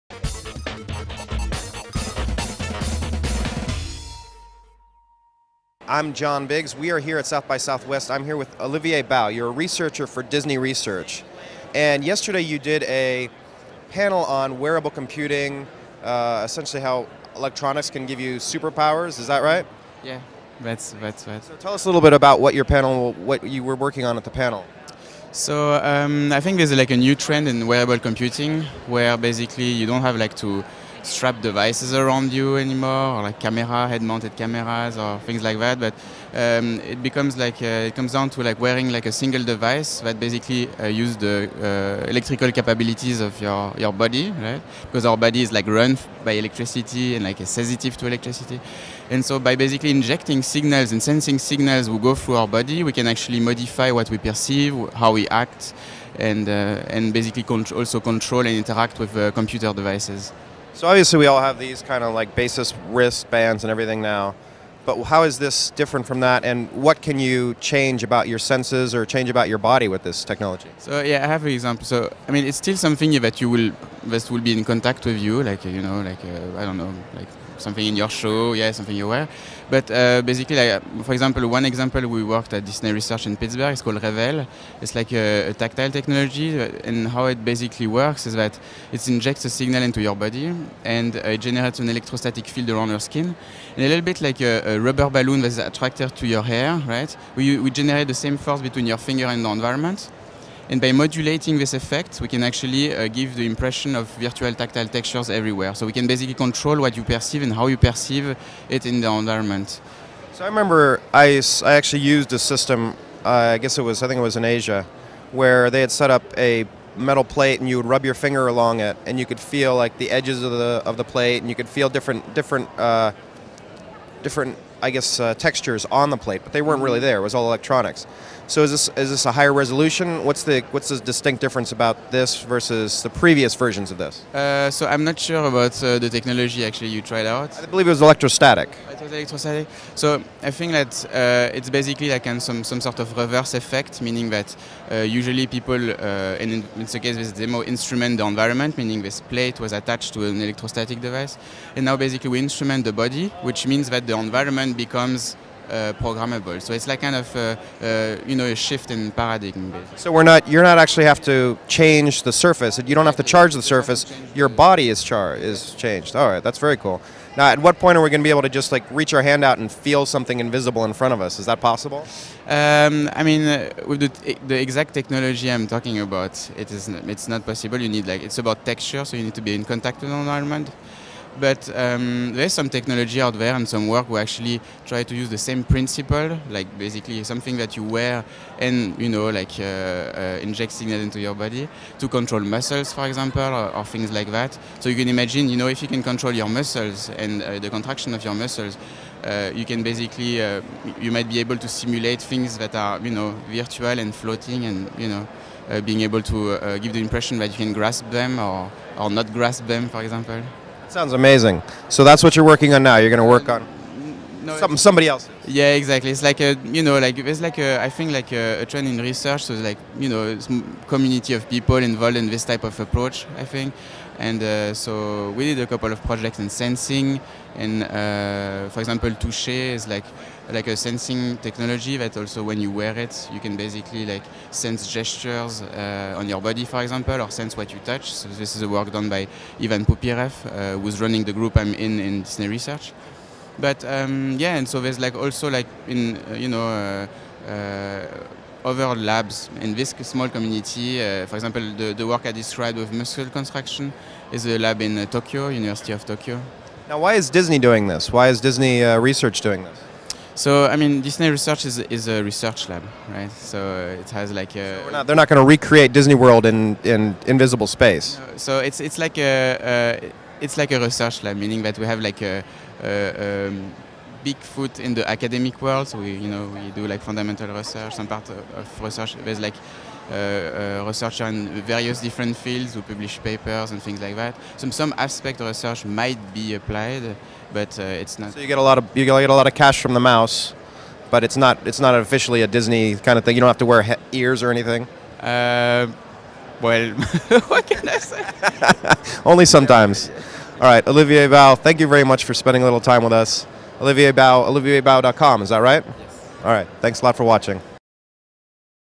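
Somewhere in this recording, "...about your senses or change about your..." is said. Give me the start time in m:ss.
1:08.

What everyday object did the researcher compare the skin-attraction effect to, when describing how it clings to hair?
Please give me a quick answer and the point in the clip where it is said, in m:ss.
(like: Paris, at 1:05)
A rubber balloon, at 1:34.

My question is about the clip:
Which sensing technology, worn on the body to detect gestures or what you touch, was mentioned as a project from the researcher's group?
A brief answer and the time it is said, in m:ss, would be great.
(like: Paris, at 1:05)
Touche, at 3:49.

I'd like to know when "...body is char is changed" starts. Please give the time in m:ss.
2:44.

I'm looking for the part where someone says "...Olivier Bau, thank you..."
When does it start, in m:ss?
5:00.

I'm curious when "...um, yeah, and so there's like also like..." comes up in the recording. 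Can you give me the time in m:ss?
4:03.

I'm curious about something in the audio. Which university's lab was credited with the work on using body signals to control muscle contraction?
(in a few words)
University of Tokyo.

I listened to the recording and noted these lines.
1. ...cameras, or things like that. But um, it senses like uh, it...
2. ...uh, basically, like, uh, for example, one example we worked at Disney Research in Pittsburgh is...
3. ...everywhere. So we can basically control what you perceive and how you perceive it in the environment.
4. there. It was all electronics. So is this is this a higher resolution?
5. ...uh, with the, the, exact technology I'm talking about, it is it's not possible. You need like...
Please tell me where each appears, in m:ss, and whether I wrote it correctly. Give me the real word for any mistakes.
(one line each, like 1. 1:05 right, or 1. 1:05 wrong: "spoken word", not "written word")
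1. 0:34 wrong: "becomes", not "senses"
2. 1:19 right
3. 1:45 right
4. 2:07 right
5. 2:53 right.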